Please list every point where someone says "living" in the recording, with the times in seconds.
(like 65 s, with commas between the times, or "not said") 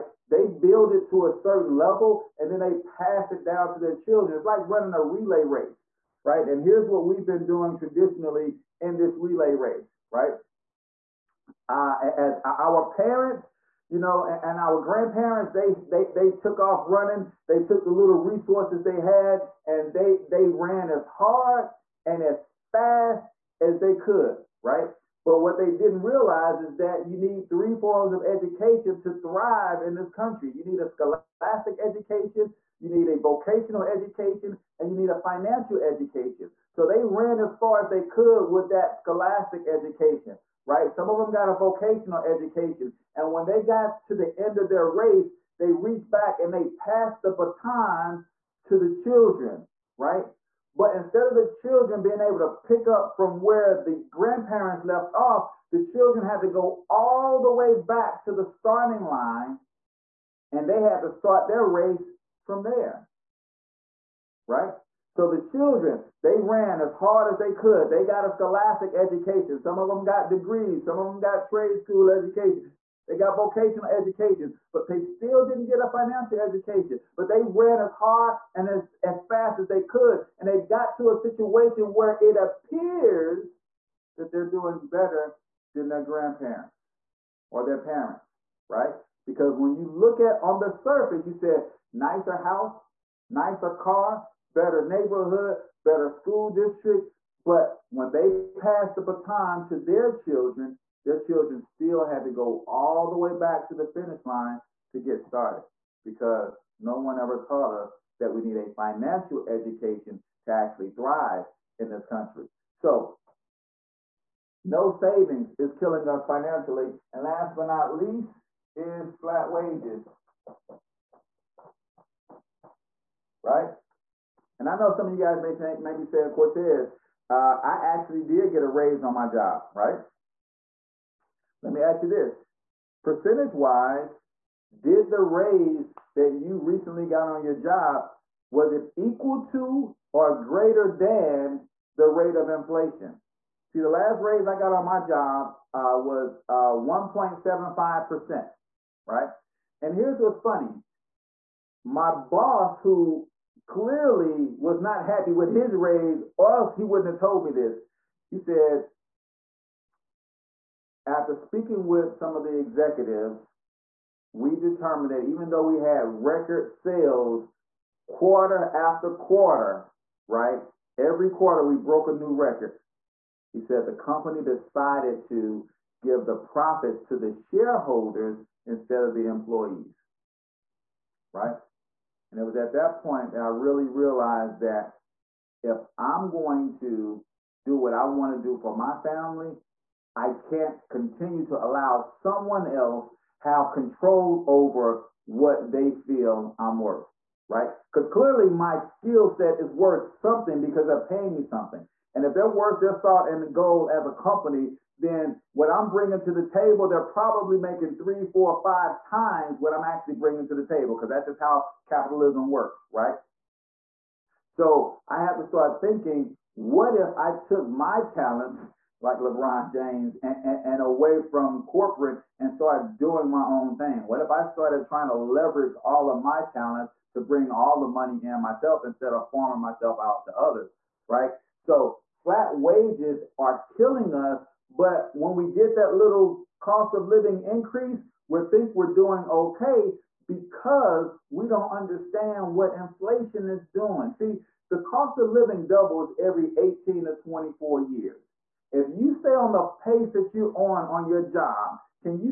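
237 s, 245 s.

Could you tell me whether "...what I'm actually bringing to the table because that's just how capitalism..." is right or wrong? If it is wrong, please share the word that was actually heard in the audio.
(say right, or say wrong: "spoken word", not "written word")
right.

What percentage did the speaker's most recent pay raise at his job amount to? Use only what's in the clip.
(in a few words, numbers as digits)
1.75%.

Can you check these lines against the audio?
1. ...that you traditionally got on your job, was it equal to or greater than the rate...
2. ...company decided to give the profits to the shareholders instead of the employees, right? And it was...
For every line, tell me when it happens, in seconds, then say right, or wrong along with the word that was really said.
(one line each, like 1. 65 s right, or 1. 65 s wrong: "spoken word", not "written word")
1. 136 s wrong: "recently", not "traditionally"
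2. 173 s right.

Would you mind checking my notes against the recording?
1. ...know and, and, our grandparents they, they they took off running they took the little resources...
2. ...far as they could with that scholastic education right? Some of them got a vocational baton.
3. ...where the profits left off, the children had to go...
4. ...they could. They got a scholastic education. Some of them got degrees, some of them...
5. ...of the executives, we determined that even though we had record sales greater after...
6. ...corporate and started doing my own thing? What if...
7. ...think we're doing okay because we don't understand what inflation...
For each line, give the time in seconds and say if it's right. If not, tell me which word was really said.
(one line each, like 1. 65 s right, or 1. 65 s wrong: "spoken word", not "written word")
1. 14 s right
2. 37 s wrong: "education", not "baton"
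3. 53 s wrong: "grandparents", not "profits"
4. 67 s right
5. 162 s wrong: "quarter", not "greater"
6. 221 s right
7. 238 s right.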